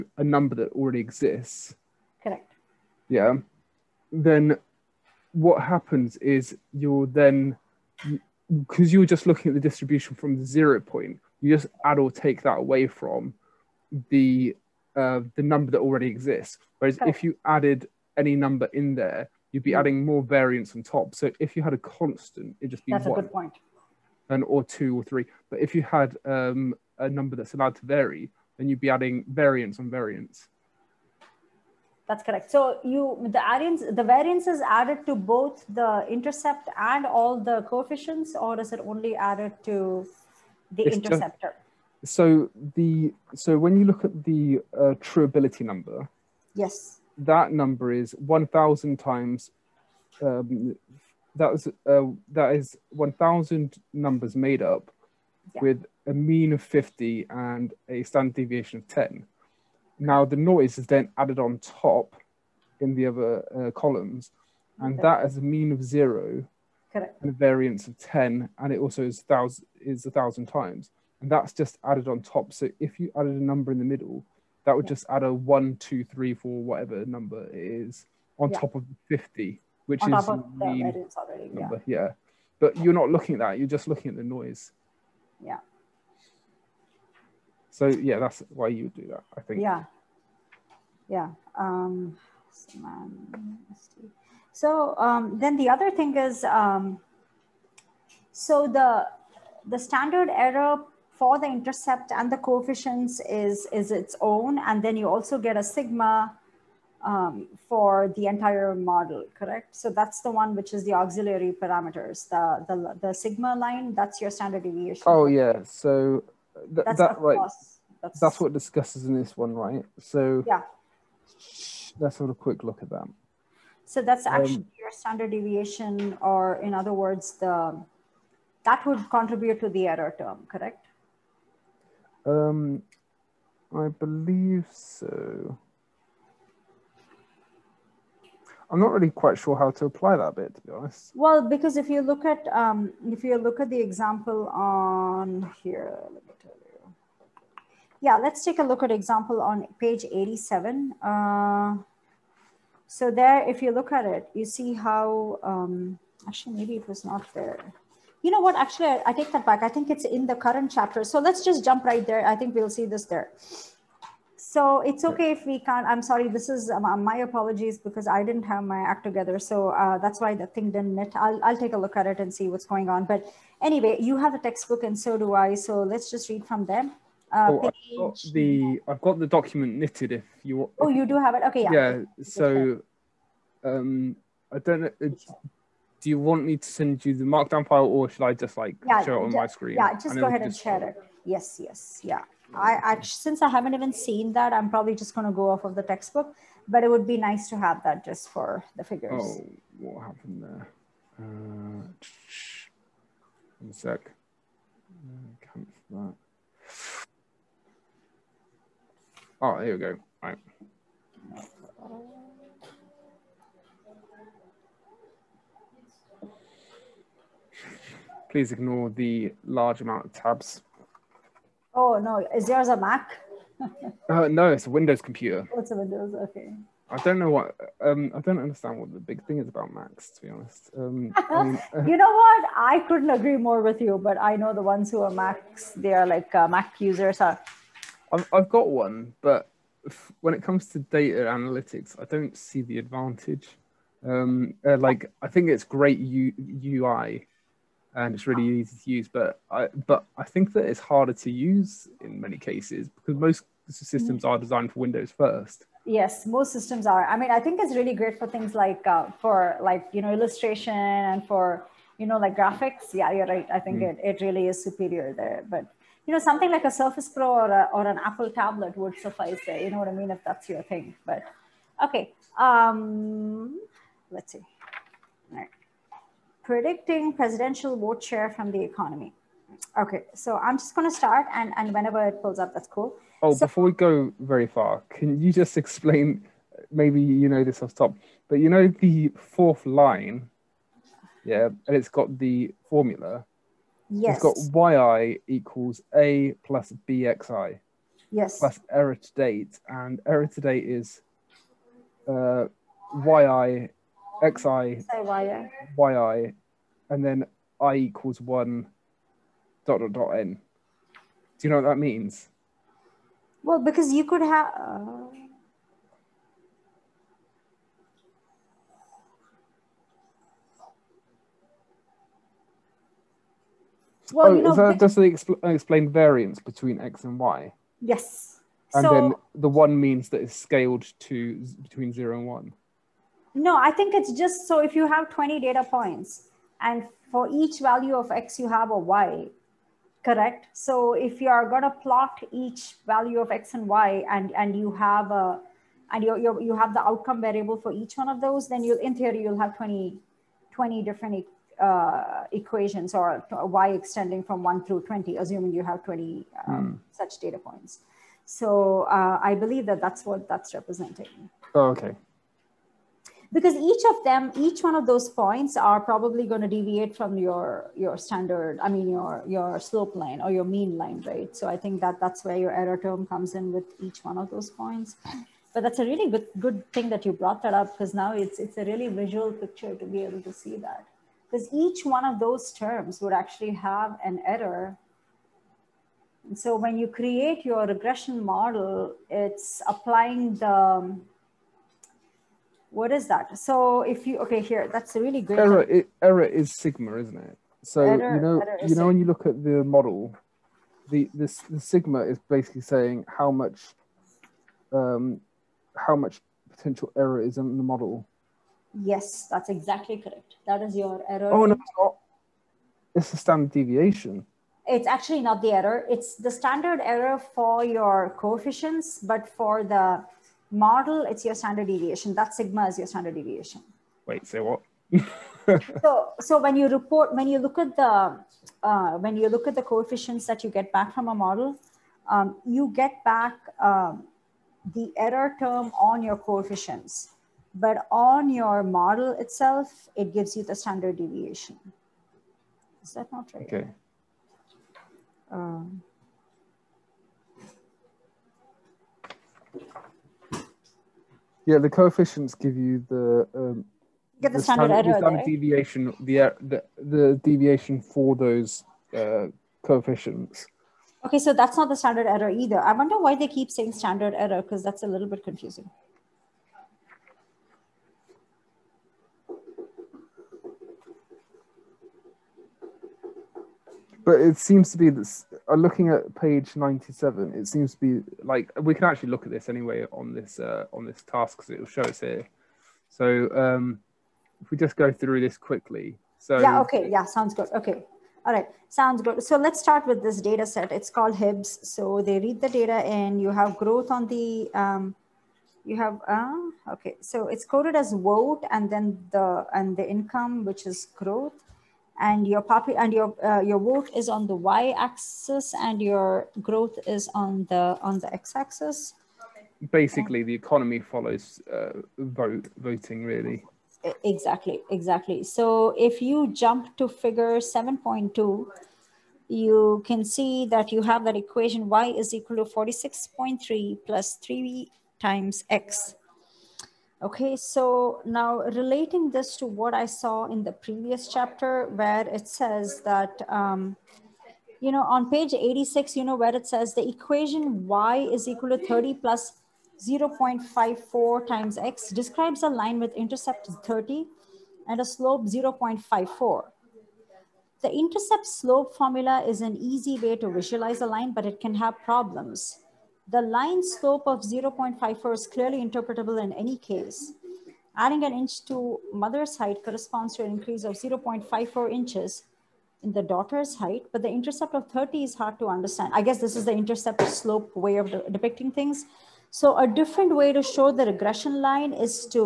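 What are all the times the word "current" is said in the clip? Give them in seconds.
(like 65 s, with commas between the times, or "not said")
160 s.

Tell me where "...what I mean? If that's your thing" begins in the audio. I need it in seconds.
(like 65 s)
269 s.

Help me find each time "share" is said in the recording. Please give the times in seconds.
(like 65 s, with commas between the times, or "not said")
190 s, 278 s.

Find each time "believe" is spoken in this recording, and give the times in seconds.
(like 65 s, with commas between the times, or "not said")
133 s, 359 s.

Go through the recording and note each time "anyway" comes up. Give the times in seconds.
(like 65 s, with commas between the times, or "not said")
173 s, 479 s.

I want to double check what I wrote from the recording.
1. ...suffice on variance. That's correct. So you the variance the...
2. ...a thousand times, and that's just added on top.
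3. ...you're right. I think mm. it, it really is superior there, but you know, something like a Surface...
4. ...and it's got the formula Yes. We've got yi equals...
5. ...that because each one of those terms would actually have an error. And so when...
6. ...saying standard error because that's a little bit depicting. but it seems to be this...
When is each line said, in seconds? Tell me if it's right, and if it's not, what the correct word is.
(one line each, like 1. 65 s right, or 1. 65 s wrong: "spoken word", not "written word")
1. 29 s wrong: "variance", not "suffice"
2. 70 s right
3. 263 s right
4. 291 s right
5. 380 s right
6. 463 s wrong: "confusing", not "depicting".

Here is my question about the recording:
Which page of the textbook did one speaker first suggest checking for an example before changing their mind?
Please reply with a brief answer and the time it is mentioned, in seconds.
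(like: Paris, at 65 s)
87, at 149 s.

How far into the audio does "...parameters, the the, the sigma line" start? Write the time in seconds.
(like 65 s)
111 s.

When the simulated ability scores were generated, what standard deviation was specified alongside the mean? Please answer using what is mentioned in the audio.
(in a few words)
10.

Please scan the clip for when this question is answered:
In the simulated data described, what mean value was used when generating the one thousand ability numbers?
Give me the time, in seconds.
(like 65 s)
56 s.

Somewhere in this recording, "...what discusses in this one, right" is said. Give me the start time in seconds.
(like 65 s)
118 s.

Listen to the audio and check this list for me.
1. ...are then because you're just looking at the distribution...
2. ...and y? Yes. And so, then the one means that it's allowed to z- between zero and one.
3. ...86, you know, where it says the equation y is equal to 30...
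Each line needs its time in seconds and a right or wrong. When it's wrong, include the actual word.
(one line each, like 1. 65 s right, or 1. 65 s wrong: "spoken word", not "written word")
1. 7 s right
2. 327 s wrong: "scaled", not "allowed"
3. 535 s right.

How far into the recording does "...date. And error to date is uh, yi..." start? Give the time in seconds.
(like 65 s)
299 s.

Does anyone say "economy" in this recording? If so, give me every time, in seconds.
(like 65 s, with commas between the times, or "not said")
278 s, 510 s.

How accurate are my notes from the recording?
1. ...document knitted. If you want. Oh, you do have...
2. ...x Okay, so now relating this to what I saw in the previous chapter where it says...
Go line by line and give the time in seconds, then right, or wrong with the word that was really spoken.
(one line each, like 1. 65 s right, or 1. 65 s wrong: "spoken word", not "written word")
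1. 179 s right
2. 525 s right.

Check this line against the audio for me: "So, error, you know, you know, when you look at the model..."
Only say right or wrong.
right.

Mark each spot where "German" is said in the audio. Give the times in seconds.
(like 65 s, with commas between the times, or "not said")
not said.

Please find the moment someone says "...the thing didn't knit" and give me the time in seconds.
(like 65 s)
170 s.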